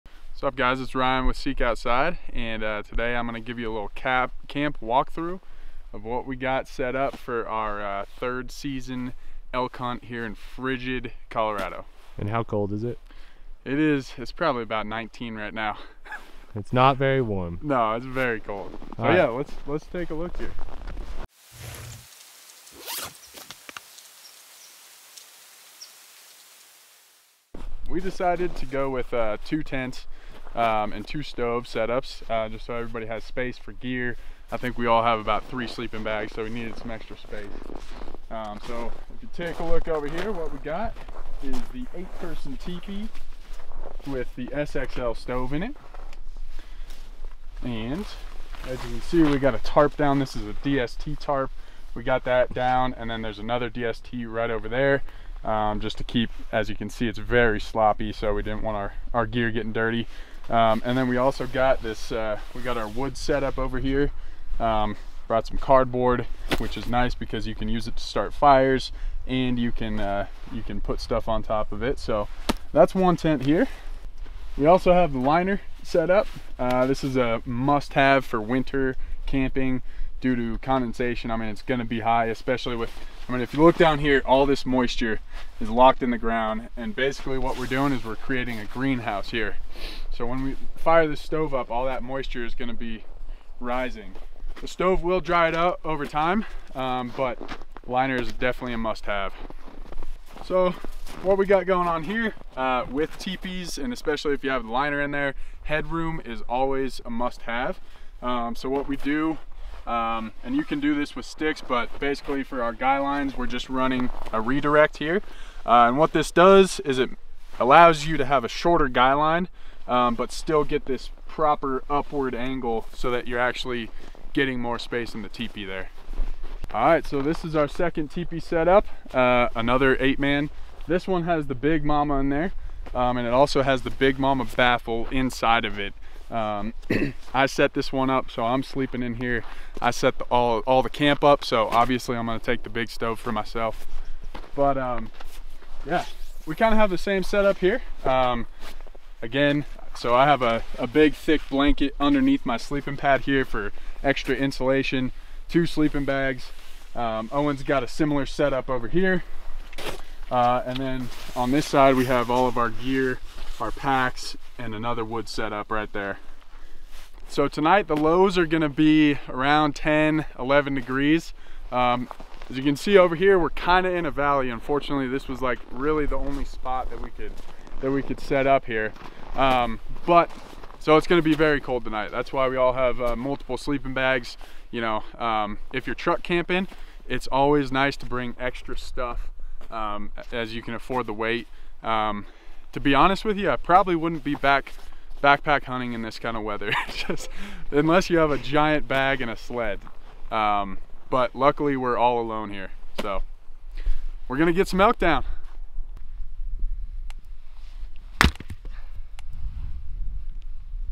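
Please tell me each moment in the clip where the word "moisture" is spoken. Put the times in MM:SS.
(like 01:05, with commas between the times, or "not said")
01:24, 01:32.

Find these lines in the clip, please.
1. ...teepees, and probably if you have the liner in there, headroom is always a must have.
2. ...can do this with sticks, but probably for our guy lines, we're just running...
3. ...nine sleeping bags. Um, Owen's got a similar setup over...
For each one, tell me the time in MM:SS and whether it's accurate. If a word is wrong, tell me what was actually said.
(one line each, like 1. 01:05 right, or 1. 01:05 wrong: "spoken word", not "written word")
1. 01:43 wrong: "especially", not "probably"
2. 01:50 wrong: "basically", not "probably"
3. 02:35 wrong: "two", not "nine".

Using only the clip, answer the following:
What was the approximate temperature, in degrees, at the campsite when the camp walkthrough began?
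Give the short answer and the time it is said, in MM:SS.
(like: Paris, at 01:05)
19, at 00:14.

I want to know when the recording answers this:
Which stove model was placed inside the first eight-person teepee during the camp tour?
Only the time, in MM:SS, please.
00:44.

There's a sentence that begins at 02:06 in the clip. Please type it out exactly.
All right, so this is our second teepee setup, uh, another eight man.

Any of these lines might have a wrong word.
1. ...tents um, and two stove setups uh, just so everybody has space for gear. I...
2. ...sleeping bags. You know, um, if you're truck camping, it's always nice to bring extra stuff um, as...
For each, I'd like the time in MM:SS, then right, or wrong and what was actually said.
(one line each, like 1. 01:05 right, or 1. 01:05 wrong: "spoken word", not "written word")
1. 00:29 right
2. 03:03 right.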